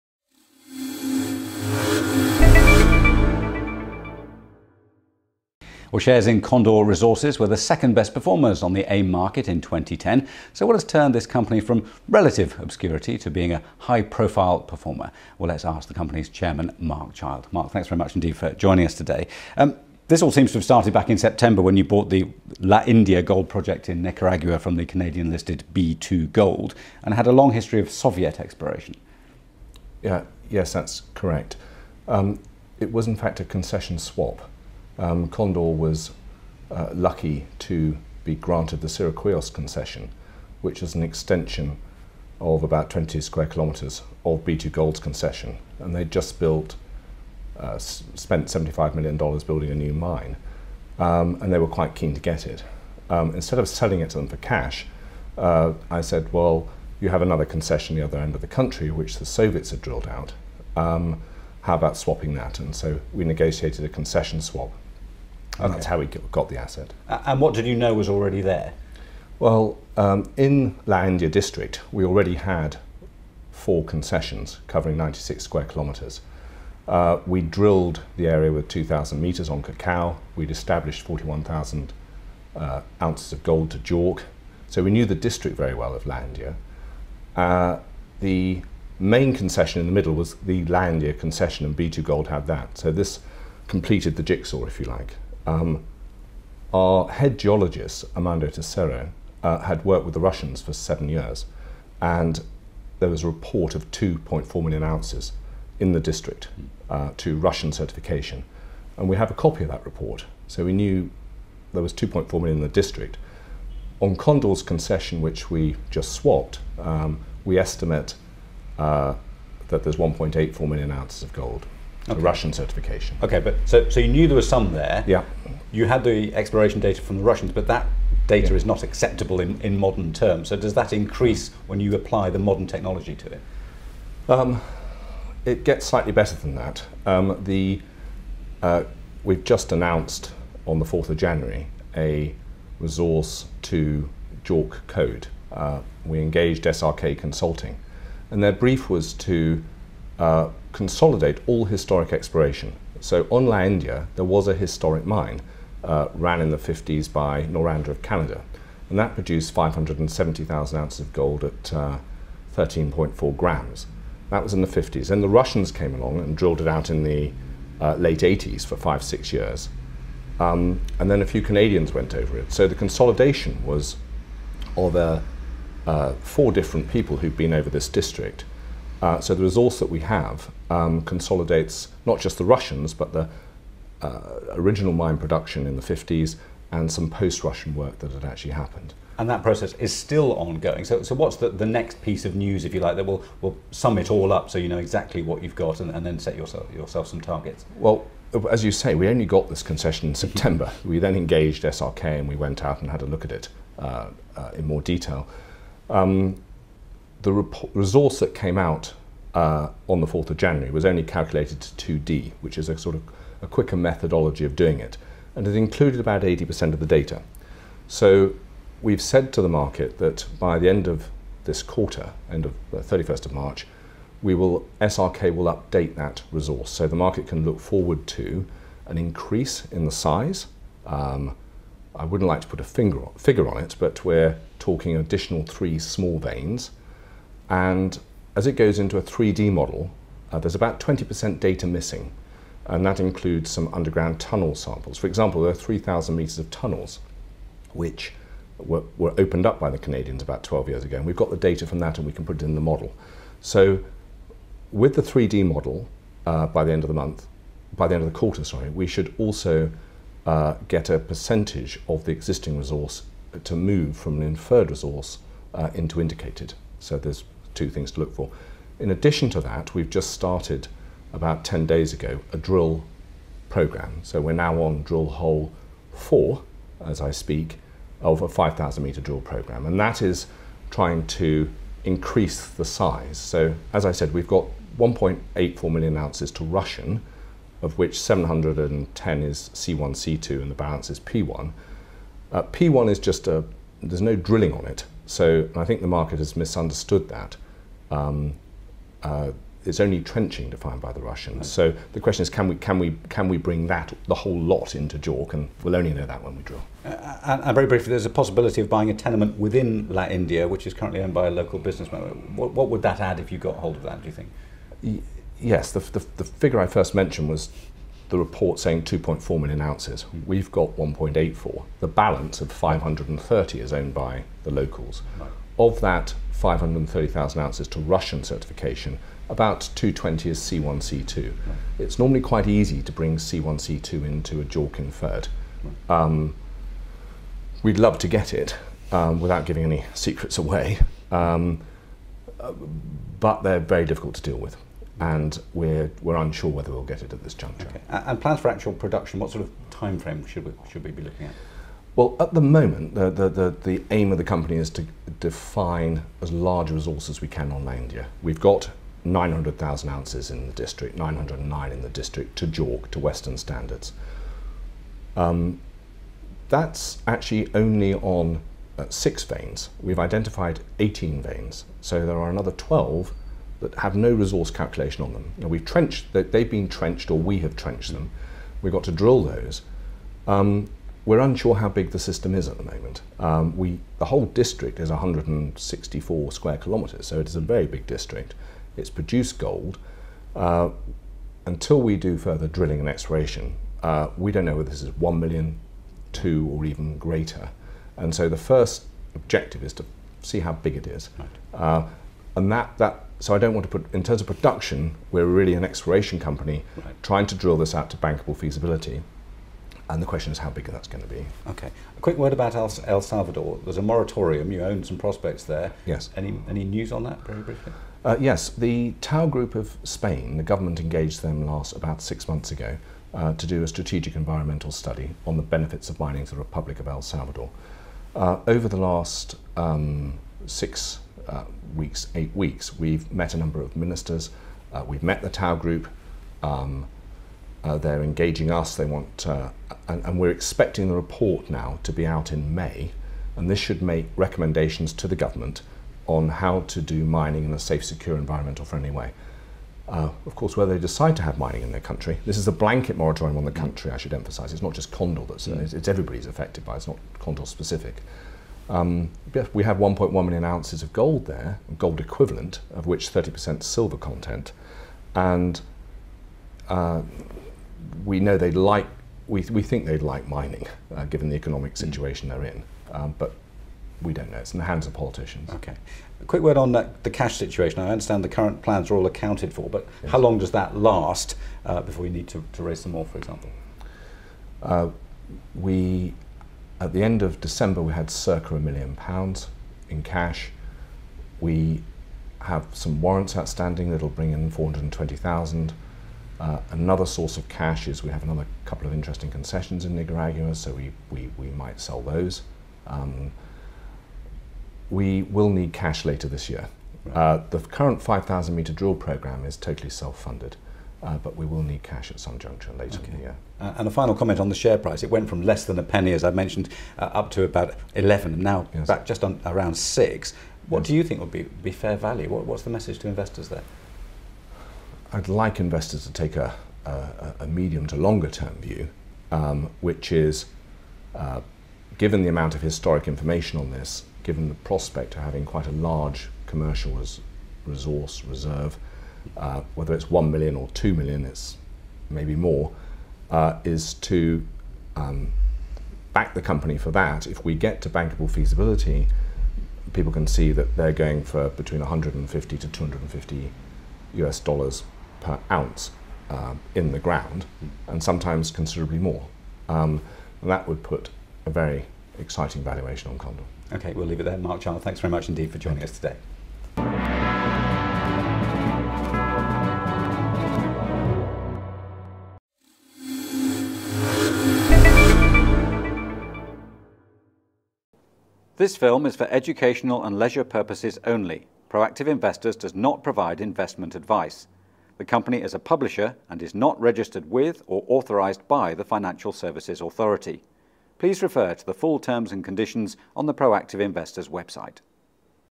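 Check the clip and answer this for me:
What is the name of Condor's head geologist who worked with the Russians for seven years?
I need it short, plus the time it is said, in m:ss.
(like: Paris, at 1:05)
Amando Tessero, at 1:38.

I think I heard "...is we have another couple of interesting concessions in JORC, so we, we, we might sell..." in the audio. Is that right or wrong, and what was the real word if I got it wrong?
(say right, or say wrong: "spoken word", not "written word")
wrong: "Nicaragua", not "JORC".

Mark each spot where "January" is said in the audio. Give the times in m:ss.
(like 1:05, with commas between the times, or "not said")
2:21, 3:30.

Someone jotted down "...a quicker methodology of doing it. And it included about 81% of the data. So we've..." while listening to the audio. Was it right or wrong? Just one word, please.
wrong.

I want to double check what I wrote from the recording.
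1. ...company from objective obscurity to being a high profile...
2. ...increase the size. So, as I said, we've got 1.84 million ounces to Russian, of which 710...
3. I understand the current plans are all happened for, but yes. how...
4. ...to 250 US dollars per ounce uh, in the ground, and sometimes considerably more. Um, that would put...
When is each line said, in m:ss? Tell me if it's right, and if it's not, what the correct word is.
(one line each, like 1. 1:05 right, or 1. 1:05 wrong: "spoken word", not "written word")
1. 0:11 wrong: "relative", not "objective"
2. 4:41 right
3. 7:57 wrong: "accounted", not "happened"
4. 9:12 right.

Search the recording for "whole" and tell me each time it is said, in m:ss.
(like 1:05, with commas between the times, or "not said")
5:04, 6:24.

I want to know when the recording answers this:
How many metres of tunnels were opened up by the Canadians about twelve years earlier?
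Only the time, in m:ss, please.
4:05.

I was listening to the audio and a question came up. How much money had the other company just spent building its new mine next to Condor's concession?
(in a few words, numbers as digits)
$75 million.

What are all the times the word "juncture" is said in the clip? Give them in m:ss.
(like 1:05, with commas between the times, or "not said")
5:47, 8:32.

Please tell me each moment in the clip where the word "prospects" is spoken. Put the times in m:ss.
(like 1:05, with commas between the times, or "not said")
6:54, 8:54.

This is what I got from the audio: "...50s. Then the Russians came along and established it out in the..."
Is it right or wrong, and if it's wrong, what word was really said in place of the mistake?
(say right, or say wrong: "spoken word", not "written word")
wrong: "drilled", not "established".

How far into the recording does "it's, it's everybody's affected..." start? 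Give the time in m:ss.
7:35.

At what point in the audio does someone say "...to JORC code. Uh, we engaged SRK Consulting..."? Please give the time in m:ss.
2:23.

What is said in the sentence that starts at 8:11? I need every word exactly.
We have some warrants outstanding that'll bring in 420,000.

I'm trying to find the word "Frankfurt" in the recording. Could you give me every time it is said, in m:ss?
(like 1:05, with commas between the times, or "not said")
not said.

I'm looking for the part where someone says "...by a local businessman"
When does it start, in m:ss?
5:11.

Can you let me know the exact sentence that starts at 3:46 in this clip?
So the market can look forward to an increase in the size.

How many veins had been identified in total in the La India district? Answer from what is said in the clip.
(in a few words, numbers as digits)
18.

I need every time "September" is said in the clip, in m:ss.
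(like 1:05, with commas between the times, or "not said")
0:21, 3:20.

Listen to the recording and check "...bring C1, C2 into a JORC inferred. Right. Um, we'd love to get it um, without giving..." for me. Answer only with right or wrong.
right.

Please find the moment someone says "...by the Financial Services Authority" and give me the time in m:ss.
9:48.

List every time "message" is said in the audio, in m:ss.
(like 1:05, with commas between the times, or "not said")
8:42.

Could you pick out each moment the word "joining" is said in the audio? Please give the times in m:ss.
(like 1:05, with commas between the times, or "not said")
0:18, 9:25.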